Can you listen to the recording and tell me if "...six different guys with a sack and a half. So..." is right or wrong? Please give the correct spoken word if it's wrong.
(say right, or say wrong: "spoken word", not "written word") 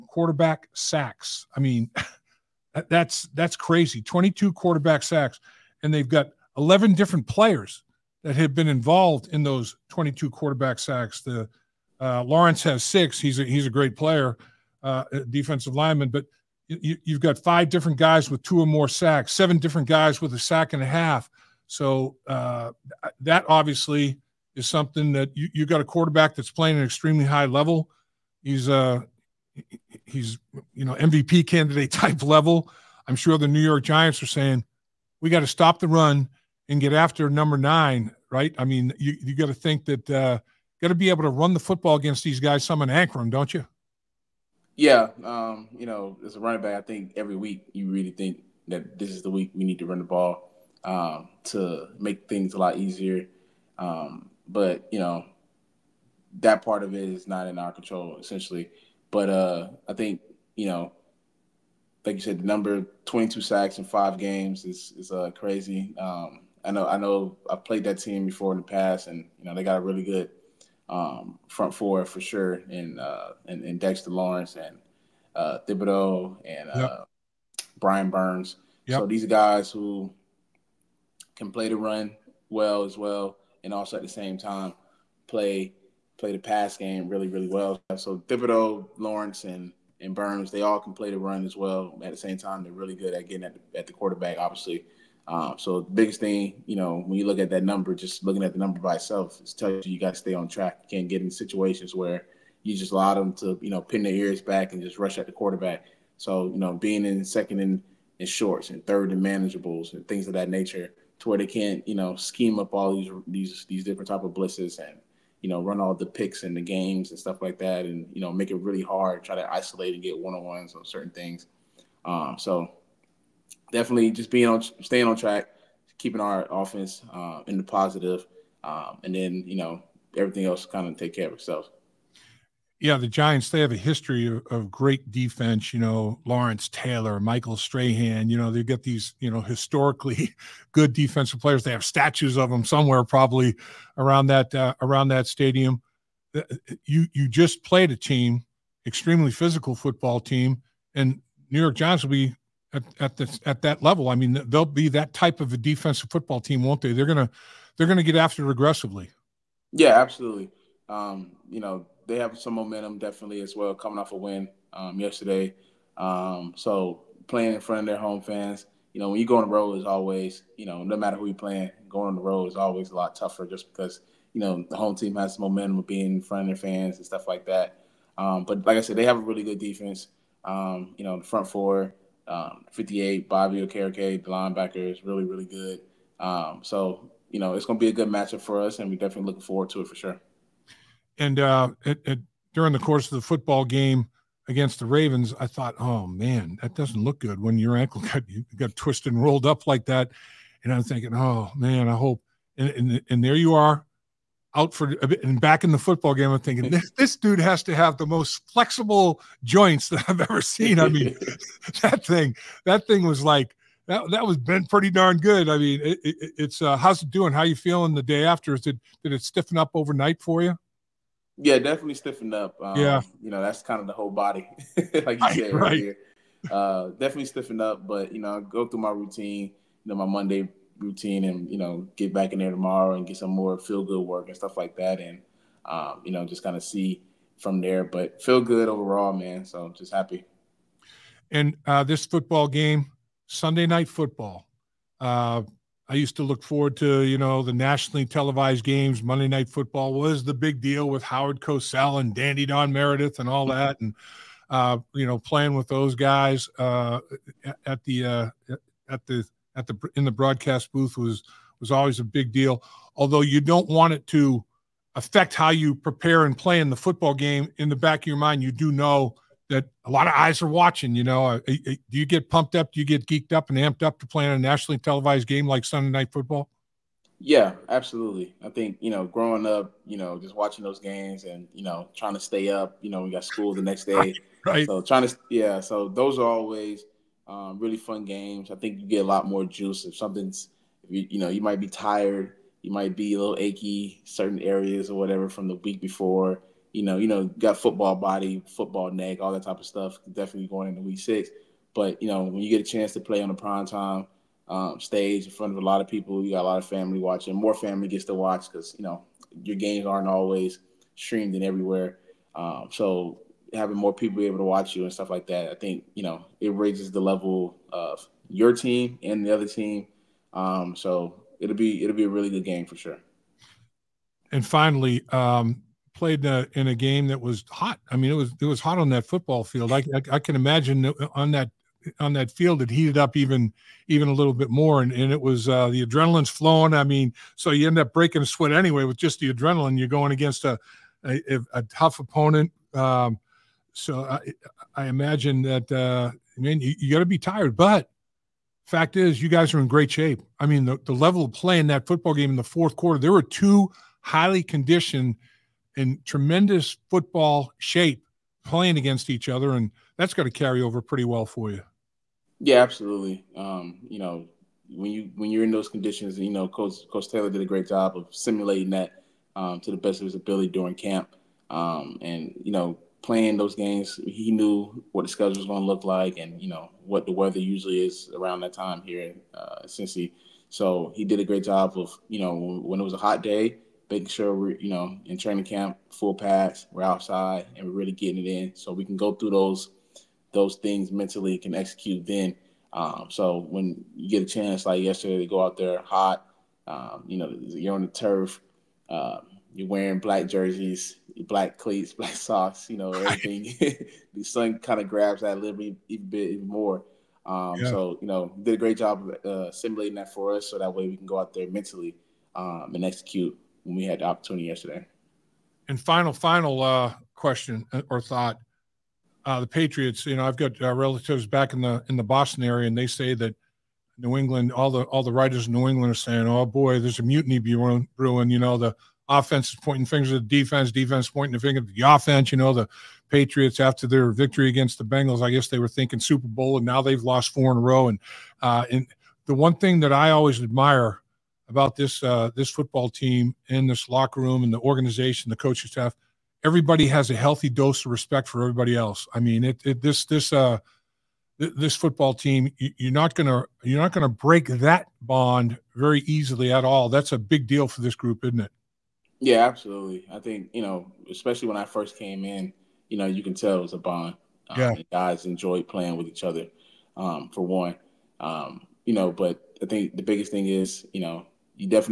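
wrong: "seven", not "six".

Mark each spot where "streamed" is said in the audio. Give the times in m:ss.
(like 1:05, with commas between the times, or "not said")
5:10.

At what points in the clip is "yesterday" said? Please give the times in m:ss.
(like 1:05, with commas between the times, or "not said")
2:44, 6:34, 6:54.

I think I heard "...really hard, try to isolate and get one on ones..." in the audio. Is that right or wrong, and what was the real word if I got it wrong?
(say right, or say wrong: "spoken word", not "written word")
right.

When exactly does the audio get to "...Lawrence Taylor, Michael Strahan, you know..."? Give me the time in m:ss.
2:16.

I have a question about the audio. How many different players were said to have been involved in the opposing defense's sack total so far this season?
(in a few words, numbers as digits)
11.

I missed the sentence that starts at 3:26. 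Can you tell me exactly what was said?
I'm thinking this, this dude has to have the most flexible joints that I've ever seen.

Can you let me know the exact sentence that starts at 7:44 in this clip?
Um, yeah, guys enjoyed playing with each other.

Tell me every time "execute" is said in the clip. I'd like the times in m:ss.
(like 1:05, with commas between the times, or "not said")
6:31, 6:52.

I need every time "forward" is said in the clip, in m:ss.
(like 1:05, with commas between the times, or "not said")
3:09, 4:06.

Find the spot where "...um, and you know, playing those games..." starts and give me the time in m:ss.
6:11.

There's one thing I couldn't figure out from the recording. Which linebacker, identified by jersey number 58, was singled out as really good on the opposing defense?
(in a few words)
Bobby Okereke.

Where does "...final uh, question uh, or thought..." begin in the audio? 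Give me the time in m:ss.
6:56.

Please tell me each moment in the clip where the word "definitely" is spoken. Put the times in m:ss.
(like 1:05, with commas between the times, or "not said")
2:03, 2:42, 3:08, 3:41, 3:46, 5:00.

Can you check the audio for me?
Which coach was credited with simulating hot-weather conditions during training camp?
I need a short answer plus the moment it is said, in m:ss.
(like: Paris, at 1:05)
Coach Taylor, at 6:06.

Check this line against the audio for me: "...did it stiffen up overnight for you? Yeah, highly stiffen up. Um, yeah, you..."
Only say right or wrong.
wrong.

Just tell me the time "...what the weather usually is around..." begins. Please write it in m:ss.
6:16.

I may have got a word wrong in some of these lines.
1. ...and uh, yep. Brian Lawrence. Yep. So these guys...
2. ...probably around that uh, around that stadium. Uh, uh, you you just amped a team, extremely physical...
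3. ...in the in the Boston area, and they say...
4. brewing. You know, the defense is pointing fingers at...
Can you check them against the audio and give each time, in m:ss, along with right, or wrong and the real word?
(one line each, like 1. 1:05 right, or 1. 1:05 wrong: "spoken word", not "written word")
1. 1:16 wrong: "Burns", not "Lawrence"
2. 2:23 wrong: "played", not "amped"
3. 7:01 right
4. 7:07 wrong: "offense", not "defense".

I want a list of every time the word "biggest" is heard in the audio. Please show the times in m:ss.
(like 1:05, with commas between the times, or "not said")
1:35, 7:50.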